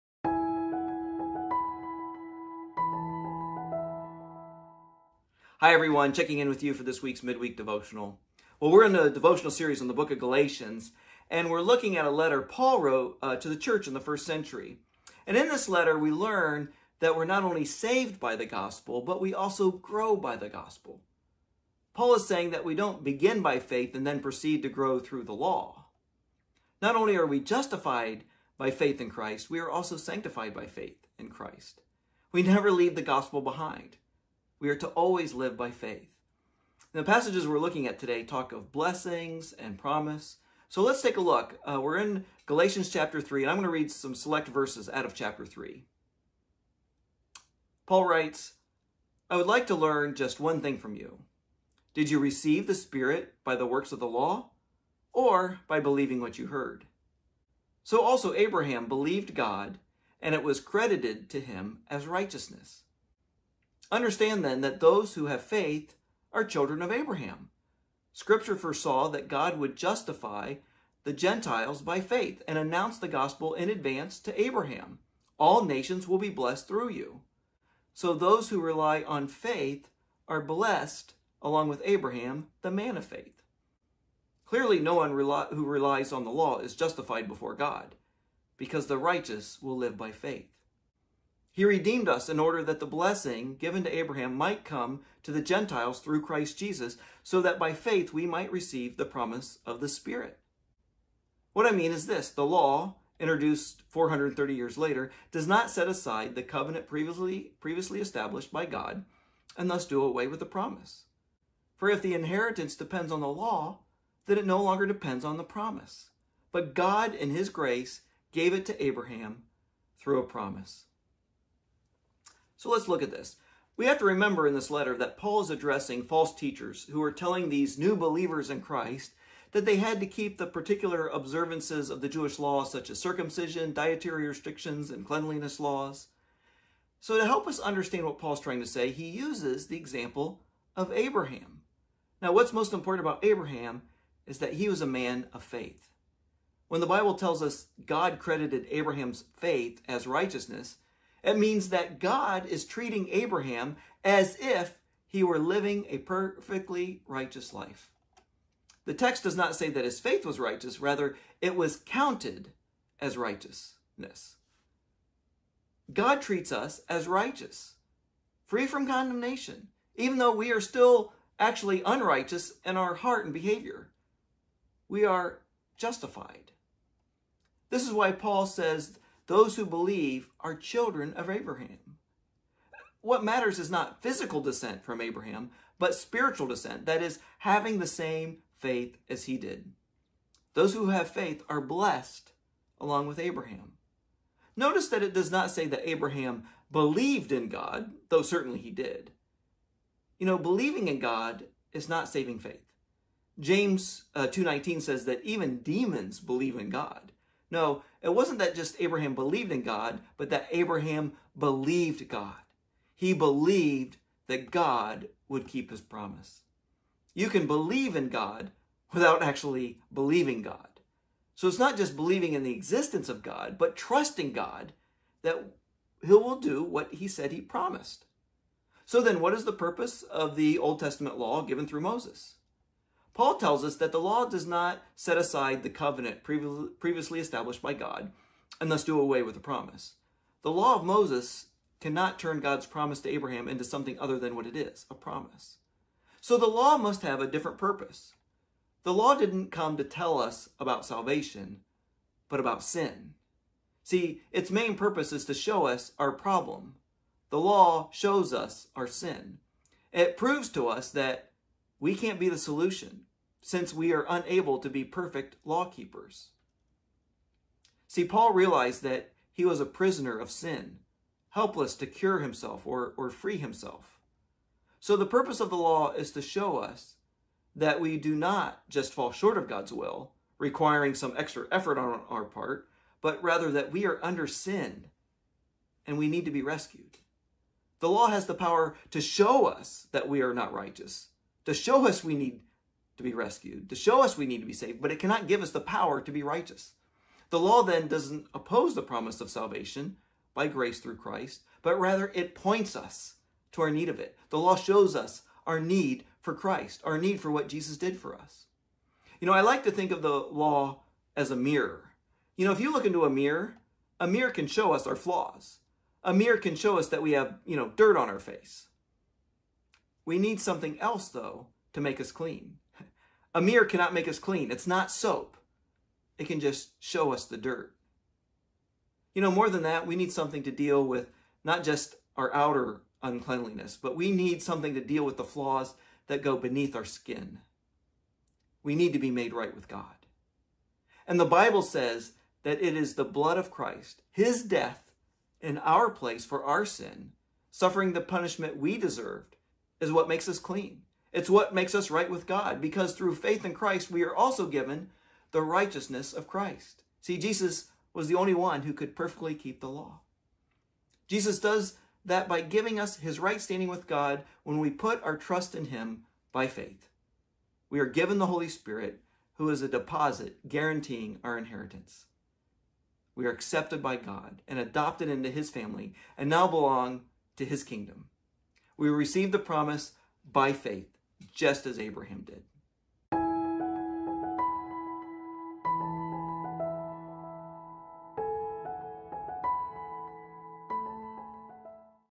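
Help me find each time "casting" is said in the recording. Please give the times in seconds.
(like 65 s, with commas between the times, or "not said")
not said.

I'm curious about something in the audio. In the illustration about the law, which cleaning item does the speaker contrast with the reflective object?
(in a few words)
Soap.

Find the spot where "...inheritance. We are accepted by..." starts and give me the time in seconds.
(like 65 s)
371 s.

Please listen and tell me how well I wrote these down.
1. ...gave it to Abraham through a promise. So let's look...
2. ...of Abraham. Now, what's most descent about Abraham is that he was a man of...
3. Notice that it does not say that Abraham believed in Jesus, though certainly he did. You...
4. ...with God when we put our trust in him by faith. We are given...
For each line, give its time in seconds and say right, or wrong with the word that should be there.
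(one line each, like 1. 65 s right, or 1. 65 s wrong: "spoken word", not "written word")
1. 118 s right
2. 140 s wrong: "important", not "descent"
3. 194 s wrong: "God", not "Jesus"
4. 363 s right.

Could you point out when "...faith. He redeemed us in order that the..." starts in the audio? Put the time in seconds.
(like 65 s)
90 s.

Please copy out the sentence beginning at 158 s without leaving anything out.
The text does not say that his faith was righteous, rather, it was counted as righteousness.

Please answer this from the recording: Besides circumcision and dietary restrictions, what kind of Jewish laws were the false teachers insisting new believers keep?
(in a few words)
Cleanliness laws.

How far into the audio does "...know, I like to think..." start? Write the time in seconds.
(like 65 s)
309 s.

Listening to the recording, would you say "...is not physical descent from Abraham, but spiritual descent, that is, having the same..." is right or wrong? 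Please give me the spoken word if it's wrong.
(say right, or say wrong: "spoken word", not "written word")
right.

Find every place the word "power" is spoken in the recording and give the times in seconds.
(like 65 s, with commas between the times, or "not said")
288 s, 295 s.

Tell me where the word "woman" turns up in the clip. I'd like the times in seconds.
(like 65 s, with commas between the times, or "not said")
not said.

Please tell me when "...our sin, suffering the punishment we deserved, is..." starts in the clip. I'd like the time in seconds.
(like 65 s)
346 s.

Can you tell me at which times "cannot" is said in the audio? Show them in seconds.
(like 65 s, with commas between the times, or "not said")
241 s, 294 s, 323 s.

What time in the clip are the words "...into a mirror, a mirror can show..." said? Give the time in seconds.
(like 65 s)
312 s.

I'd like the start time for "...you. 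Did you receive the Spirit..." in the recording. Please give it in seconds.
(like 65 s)
50 s.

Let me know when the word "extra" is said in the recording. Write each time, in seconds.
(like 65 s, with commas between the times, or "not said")
281 s.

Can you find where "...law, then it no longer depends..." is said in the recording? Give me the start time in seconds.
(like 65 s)
113 s.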